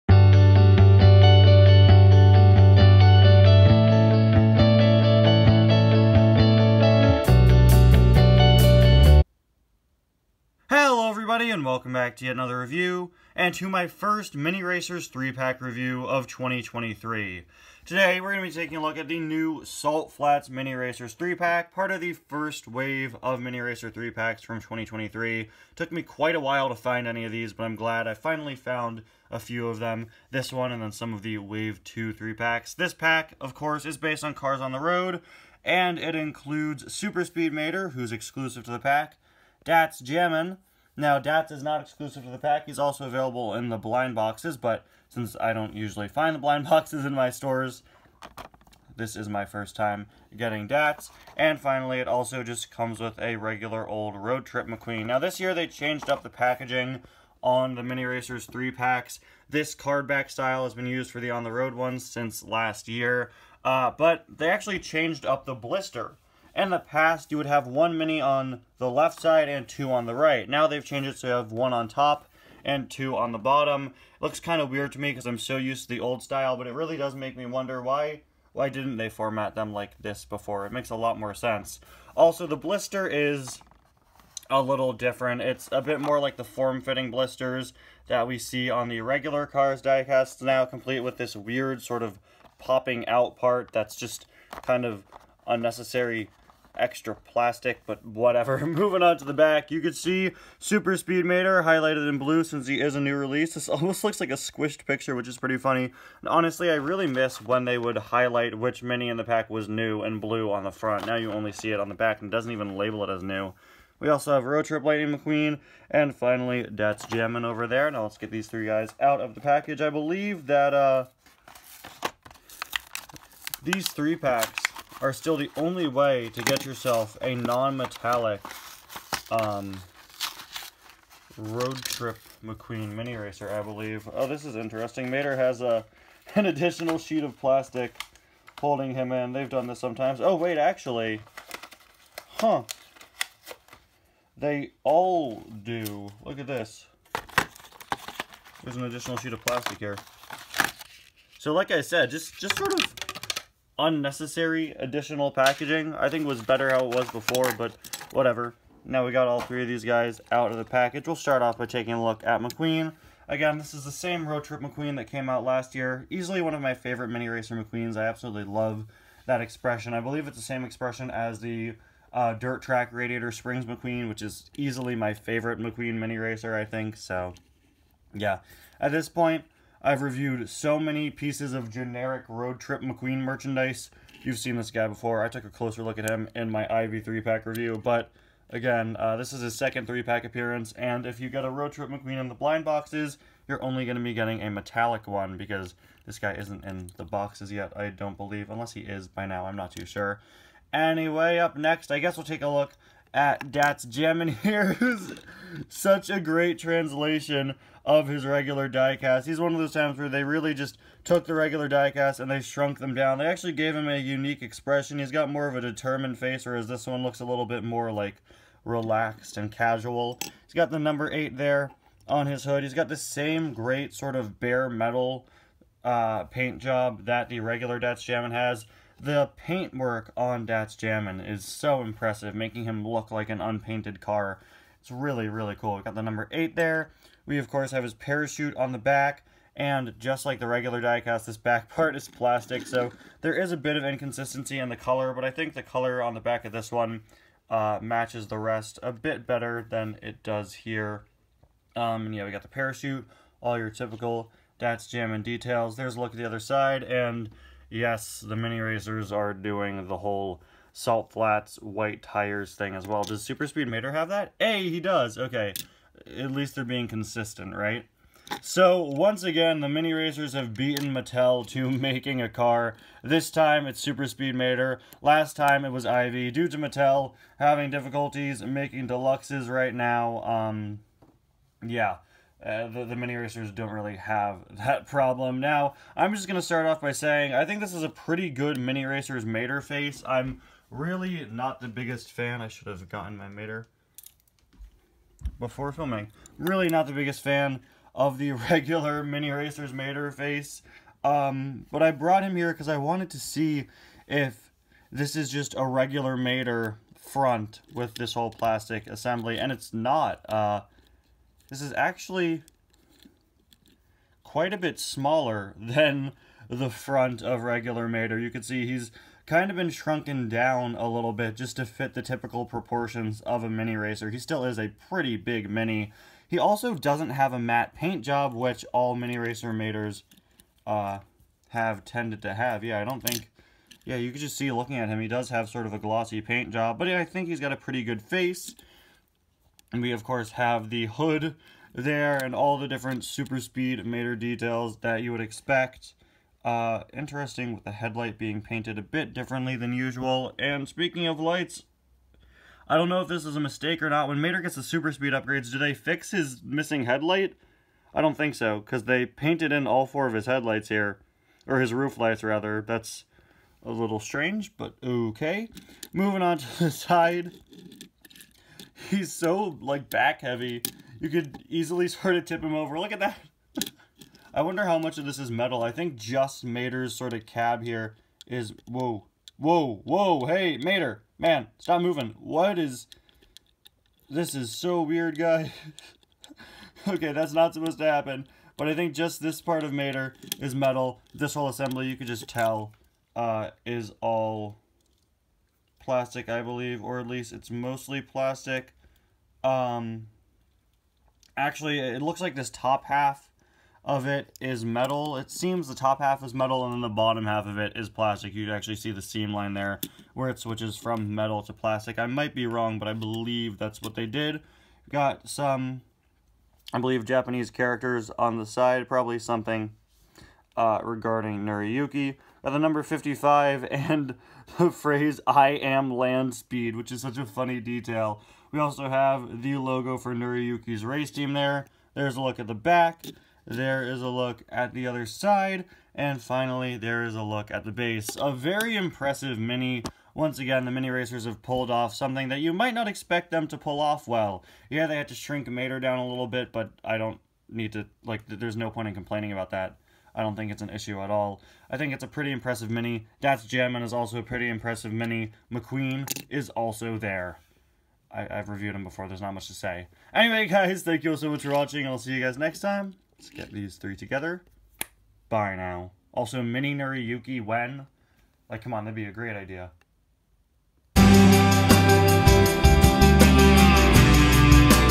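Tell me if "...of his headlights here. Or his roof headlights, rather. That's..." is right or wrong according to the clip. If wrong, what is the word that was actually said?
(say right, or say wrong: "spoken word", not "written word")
wrong: "lights", not "headlights".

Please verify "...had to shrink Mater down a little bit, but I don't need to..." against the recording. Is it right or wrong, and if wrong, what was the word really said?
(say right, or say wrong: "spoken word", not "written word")
right.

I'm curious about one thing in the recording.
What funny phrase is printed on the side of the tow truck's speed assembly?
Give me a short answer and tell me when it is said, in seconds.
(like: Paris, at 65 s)
I am land speed, at 425 s.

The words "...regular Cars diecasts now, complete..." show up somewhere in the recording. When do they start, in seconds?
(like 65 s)
88 s.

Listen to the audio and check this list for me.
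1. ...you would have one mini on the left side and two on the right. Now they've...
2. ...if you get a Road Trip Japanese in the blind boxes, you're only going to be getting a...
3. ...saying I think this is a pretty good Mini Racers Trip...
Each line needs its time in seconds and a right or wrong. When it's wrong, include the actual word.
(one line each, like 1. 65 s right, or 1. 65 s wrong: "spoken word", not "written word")
1. 67 s right
2. 191 s wrong: "McQueen", not "Japanese"
3. 286 s wrong: "Mater", not "Trip".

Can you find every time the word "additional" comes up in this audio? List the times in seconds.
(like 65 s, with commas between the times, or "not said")
136 s, 148 s, 154 s.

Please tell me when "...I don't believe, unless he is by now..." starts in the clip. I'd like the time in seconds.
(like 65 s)
197 s.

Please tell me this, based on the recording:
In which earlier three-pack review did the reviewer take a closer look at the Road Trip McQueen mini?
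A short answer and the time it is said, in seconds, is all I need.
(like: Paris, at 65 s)
Ivy 3-pack, at 186 s.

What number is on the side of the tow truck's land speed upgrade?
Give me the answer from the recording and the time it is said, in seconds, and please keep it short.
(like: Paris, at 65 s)
55, at 422 s.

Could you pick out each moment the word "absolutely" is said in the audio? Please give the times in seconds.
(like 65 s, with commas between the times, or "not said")
168 s.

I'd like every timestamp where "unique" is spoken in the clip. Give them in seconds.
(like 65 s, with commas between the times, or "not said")
213 s.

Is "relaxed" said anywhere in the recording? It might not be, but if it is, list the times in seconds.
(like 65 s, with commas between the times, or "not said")
218 s.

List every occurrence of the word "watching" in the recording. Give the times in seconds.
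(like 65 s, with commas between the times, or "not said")
461 s.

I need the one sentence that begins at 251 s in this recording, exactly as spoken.
Um, and yeah, we got the parachute, all your typical Datz Jammin details.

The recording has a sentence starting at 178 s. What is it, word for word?
At this point, I've reviewed so many pieces of generic Road Trip McQueen merchandise.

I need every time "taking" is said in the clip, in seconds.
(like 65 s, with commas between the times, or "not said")
18 s, 161 s.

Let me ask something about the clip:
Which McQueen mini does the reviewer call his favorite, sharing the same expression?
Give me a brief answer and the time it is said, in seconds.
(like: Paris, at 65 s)
Dirt Track Radiator Springs McQueen, at 172 s.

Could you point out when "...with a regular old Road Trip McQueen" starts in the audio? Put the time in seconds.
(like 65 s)
52 s.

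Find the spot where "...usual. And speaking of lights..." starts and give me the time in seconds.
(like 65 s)
349 s.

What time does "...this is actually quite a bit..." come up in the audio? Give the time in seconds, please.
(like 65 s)
311 s.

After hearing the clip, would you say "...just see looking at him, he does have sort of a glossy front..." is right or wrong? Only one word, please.
wrong.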